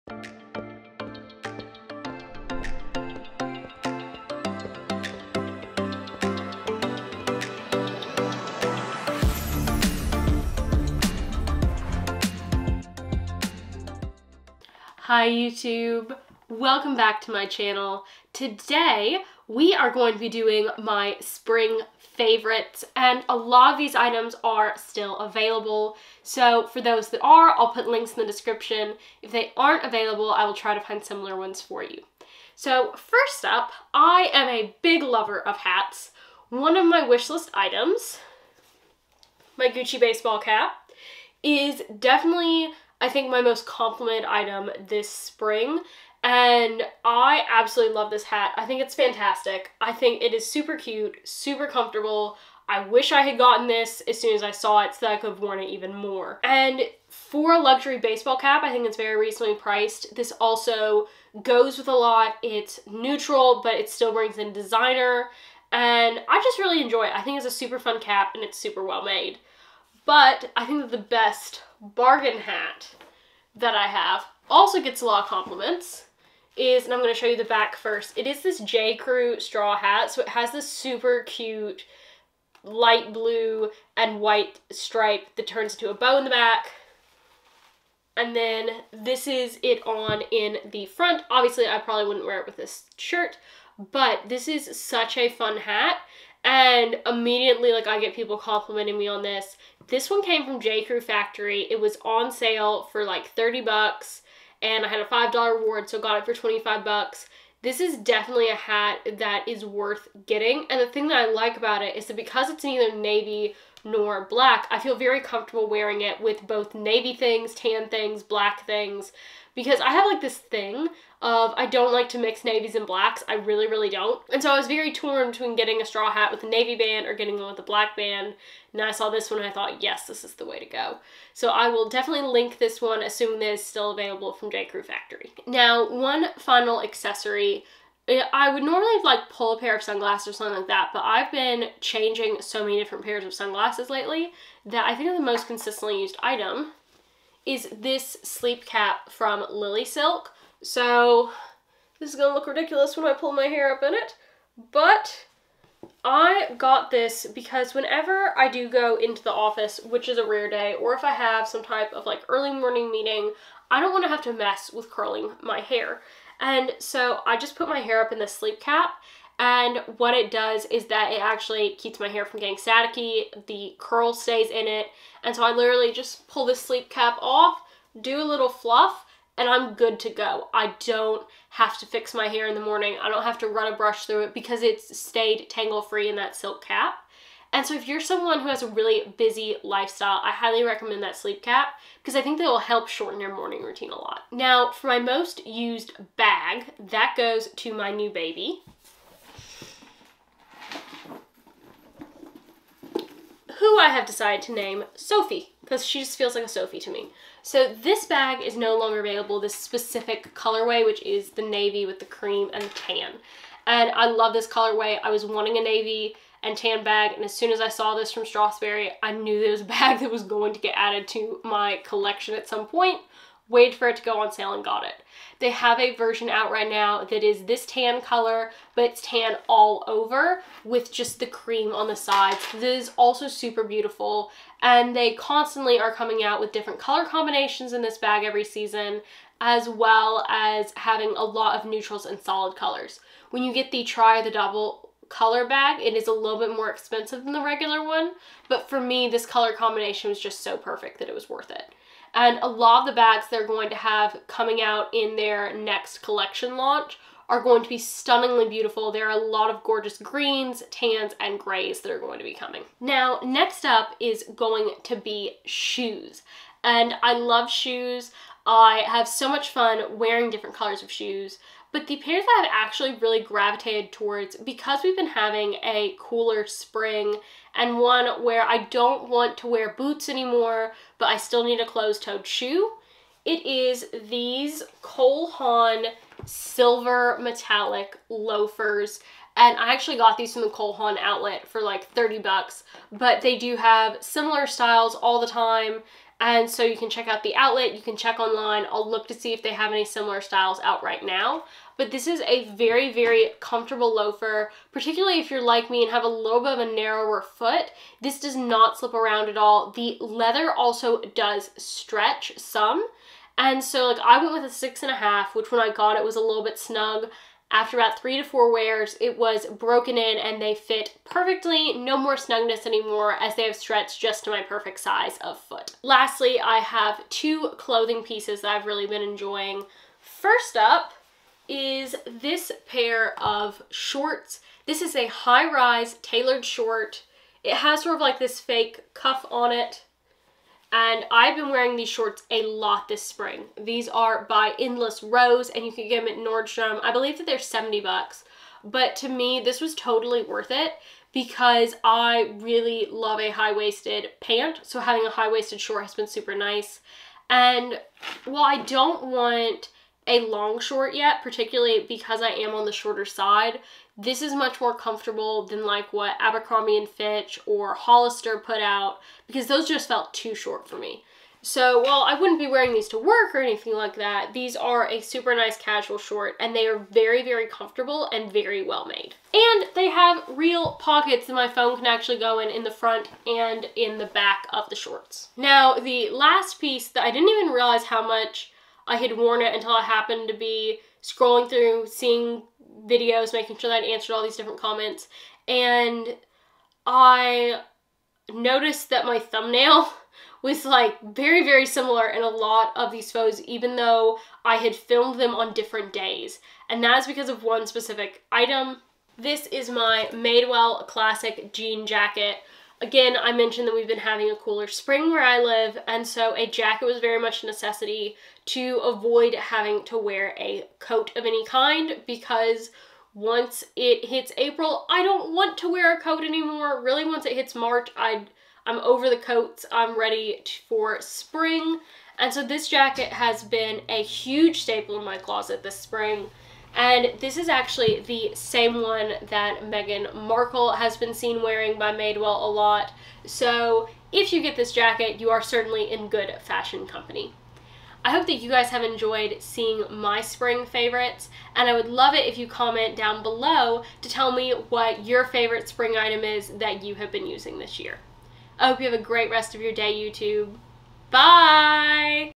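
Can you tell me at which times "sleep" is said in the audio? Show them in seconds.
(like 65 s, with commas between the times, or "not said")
148 s, 168 s, 176 s, 191 s.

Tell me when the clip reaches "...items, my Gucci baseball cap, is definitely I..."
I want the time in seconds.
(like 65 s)
37 s.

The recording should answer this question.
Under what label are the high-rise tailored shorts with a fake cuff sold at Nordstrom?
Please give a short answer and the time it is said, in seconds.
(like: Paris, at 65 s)
Endless Rose, at 344 s.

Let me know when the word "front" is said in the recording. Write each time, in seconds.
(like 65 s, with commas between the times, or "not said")
90 s, 382 s.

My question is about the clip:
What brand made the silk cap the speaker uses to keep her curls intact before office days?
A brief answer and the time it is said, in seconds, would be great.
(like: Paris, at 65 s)
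Lily Silk, at 149 s.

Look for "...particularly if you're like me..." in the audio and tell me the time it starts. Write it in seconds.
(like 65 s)
304 s.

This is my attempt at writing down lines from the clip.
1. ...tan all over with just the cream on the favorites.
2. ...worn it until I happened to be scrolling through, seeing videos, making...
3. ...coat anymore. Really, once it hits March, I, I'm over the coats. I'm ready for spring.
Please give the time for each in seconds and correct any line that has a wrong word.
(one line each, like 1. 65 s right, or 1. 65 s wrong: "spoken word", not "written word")
1. 229 s wrong: "sides", not "favorites"
2. 389 s right
3. 426 s right.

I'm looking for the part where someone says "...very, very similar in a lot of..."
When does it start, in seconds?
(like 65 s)
401 s.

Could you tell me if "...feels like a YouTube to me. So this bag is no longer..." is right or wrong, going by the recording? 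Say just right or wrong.
wrong.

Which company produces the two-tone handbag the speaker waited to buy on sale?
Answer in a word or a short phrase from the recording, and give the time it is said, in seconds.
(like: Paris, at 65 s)
Strathberry, at 218 s.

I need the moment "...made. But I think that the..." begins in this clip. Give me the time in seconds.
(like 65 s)
69 s.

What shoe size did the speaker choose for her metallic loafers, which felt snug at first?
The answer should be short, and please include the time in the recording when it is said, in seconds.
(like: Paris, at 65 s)
6.5, at 314 s.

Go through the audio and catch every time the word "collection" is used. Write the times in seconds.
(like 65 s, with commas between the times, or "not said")
221 s, 256 s.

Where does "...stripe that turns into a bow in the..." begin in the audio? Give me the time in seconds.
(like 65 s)
84 s.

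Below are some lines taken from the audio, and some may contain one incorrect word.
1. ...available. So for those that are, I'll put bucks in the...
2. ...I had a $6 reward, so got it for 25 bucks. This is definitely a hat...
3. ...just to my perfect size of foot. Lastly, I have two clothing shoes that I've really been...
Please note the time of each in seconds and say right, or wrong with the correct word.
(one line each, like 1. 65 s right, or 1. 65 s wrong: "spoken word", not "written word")
1. 25 s wrong: "links", not "bucks"
2. 104 s wrong: "5", not "6"
3. 323 s wrong: "pieces", not "shoes".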